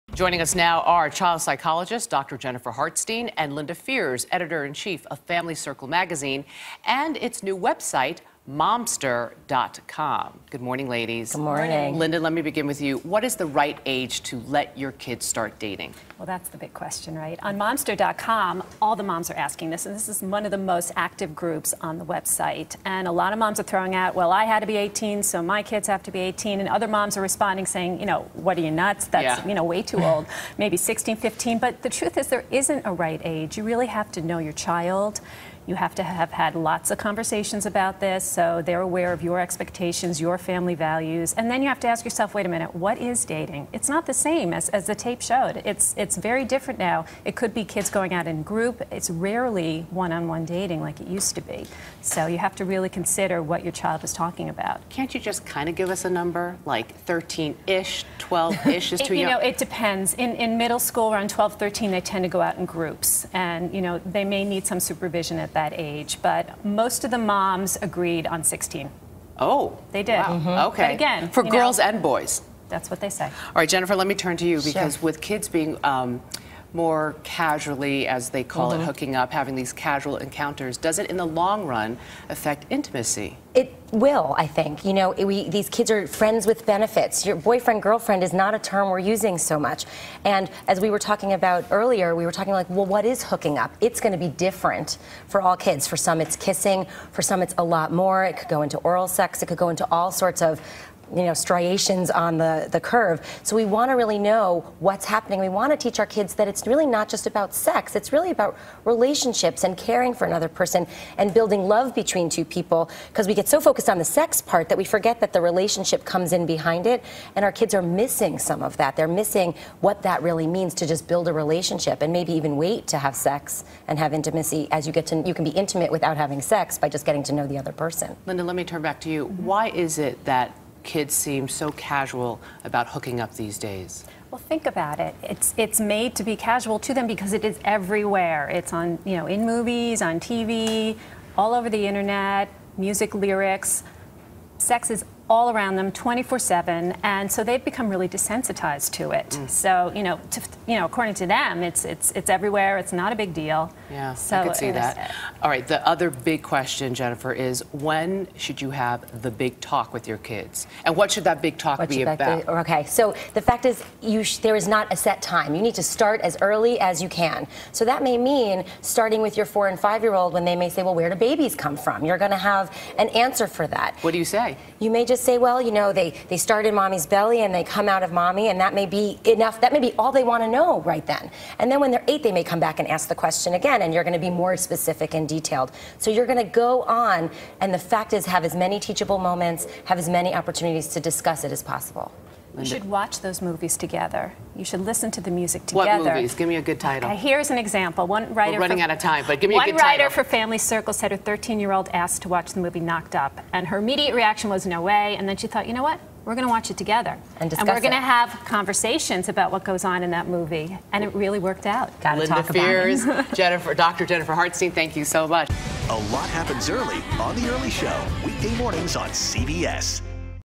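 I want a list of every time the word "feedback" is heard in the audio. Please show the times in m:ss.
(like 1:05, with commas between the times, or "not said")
not said.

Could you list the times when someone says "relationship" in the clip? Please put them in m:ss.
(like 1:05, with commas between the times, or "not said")
1:48, 1:55, 2:01.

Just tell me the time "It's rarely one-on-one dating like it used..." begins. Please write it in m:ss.
0:48.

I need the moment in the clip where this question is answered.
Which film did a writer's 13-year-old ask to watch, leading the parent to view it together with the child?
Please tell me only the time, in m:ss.
3:22.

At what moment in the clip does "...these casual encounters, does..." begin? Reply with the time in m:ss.
1:19.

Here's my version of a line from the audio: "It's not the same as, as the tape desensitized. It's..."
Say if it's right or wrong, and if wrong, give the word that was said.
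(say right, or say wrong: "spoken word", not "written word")
wrong: "showed", not "desensitized".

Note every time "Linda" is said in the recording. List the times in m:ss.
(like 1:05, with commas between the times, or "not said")
0:03, 0:11, 2:08.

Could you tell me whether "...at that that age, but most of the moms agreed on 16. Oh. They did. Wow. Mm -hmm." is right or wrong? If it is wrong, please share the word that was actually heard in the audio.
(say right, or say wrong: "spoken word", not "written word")
right.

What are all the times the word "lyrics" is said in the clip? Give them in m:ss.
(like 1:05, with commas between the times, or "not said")
2:23.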